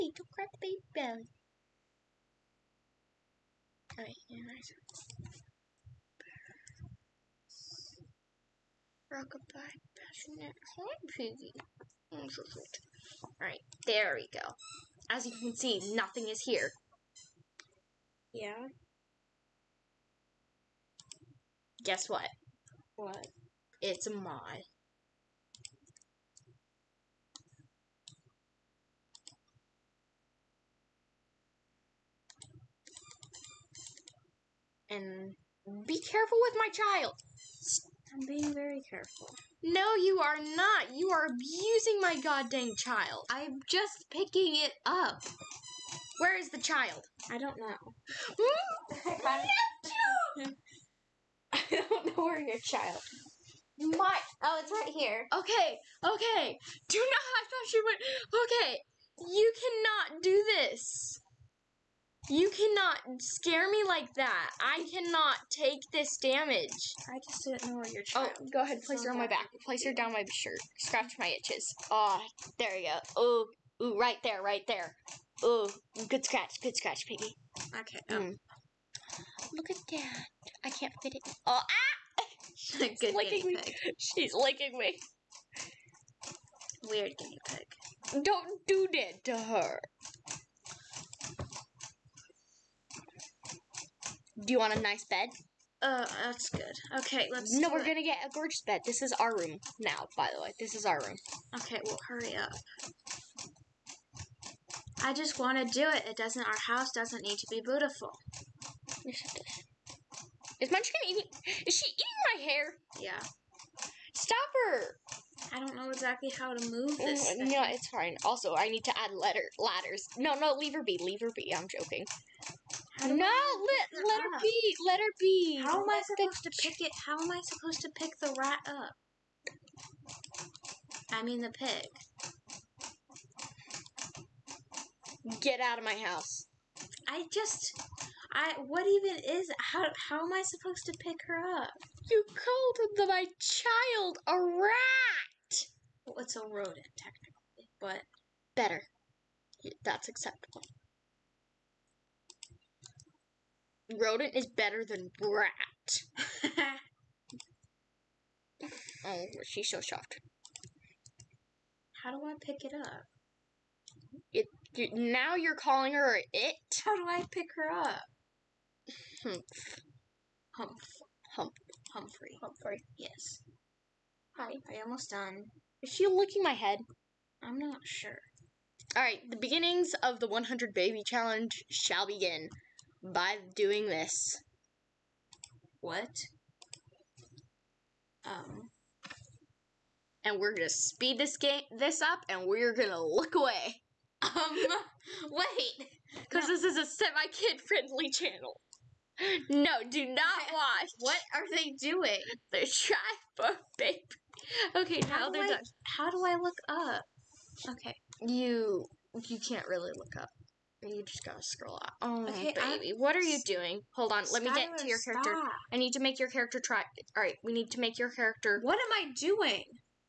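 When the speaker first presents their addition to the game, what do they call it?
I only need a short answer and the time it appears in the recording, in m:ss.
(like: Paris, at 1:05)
a mod, at 0:23.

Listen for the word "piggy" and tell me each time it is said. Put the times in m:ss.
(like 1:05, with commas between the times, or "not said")
0:11, 1:17.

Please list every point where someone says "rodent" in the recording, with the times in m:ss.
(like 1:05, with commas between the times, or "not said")
2:26, 2:33.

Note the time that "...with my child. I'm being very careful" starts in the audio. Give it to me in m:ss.
0:36.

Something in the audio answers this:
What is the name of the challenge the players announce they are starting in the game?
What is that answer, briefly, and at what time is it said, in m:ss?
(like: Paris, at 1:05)
100 Baby Challenge, at 3:00.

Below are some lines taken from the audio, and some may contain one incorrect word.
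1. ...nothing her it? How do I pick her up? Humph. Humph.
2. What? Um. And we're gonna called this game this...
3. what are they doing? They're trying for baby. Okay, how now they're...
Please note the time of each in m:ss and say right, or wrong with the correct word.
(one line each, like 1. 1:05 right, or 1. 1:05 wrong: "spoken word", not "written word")
1. 2:45 wrong: "calling", not "nothing"
2. 3:05 wrong: "speed", not "called"
3. 3:20 right.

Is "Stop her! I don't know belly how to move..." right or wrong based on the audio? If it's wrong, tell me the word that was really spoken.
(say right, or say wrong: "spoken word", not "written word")
wrong: "exactly", not "belly".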